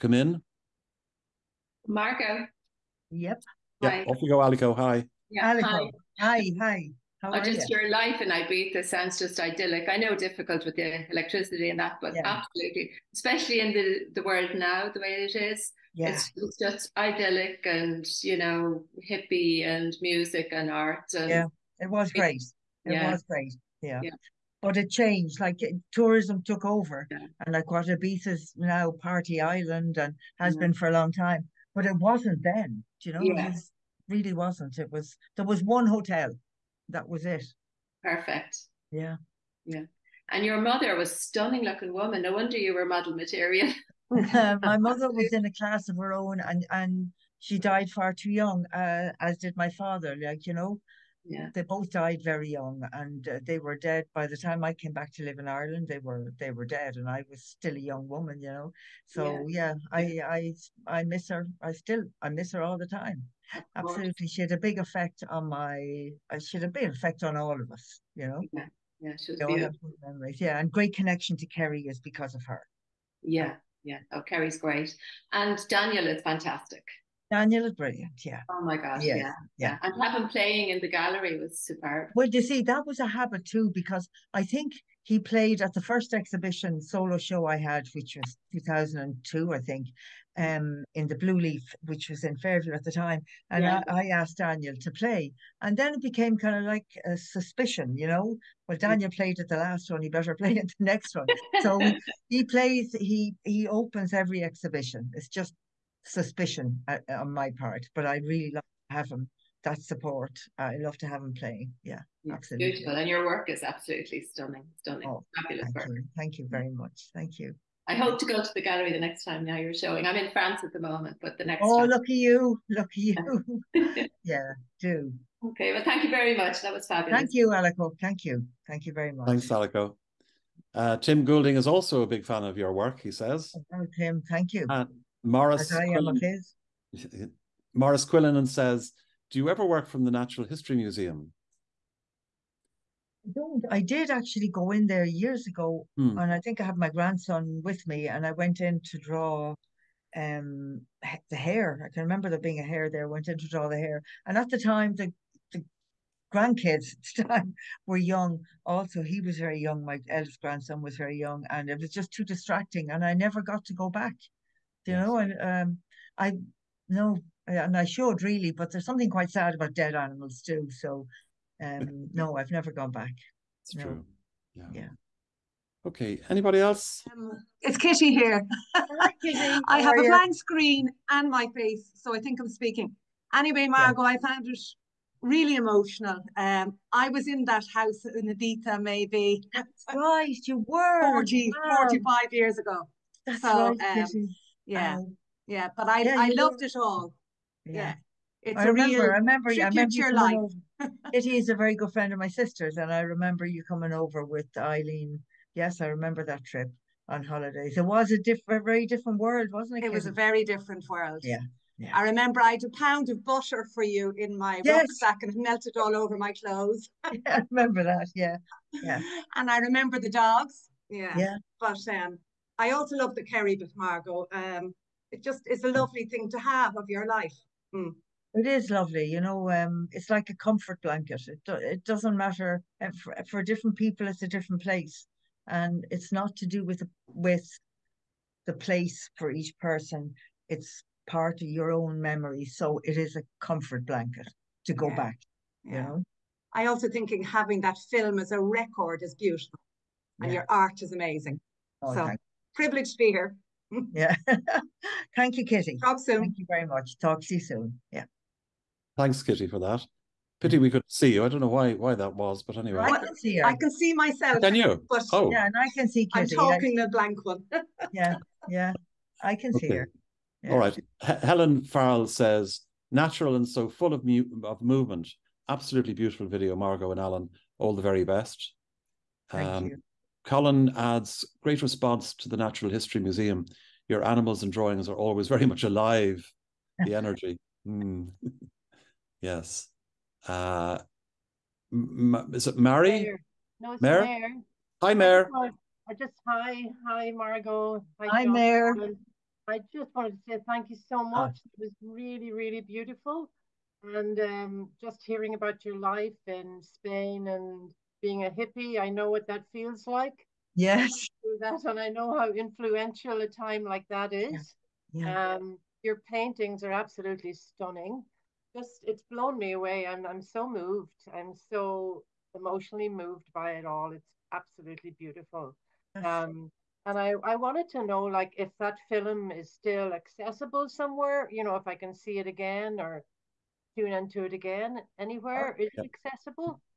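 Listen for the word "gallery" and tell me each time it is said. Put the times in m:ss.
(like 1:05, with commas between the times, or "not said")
1:20, 1:58.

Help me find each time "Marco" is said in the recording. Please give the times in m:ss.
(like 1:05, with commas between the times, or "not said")
0:01.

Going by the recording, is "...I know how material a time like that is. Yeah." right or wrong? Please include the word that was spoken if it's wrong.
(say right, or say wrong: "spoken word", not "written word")
wrong: "influential", not "material".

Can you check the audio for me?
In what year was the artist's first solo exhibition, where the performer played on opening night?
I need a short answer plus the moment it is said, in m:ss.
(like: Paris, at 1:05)
2002, at 1:28.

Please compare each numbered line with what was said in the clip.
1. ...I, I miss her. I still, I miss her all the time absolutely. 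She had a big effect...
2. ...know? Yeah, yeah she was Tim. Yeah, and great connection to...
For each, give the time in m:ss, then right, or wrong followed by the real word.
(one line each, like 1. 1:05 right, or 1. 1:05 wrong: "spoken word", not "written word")
1. 1:00 right
2. 1:08 wrong: "Memories", not "Tim".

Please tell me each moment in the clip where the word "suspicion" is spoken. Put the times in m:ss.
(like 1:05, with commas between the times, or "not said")
1:37, 1:46.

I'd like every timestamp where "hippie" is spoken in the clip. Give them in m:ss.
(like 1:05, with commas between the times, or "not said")
0:19, 5:08.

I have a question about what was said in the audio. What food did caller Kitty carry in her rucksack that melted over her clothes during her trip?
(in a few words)
a pound of butter.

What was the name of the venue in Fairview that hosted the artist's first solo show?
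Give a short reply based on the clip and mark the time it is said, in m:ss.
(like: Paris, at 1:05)
Blue Leaf, at 1:31.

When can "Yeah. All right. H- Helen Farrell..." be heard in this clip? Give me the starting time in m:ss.
4:30.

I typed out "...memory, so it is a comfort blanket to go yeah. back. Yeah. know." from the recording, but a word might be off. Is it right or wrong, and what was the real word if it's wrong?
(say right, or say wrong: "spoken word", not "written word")
right.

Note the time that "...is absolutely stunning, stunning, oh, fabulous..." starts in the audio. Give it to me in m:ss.
1:53.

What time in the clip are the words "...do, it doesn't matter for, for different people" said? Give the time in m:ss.
3:51.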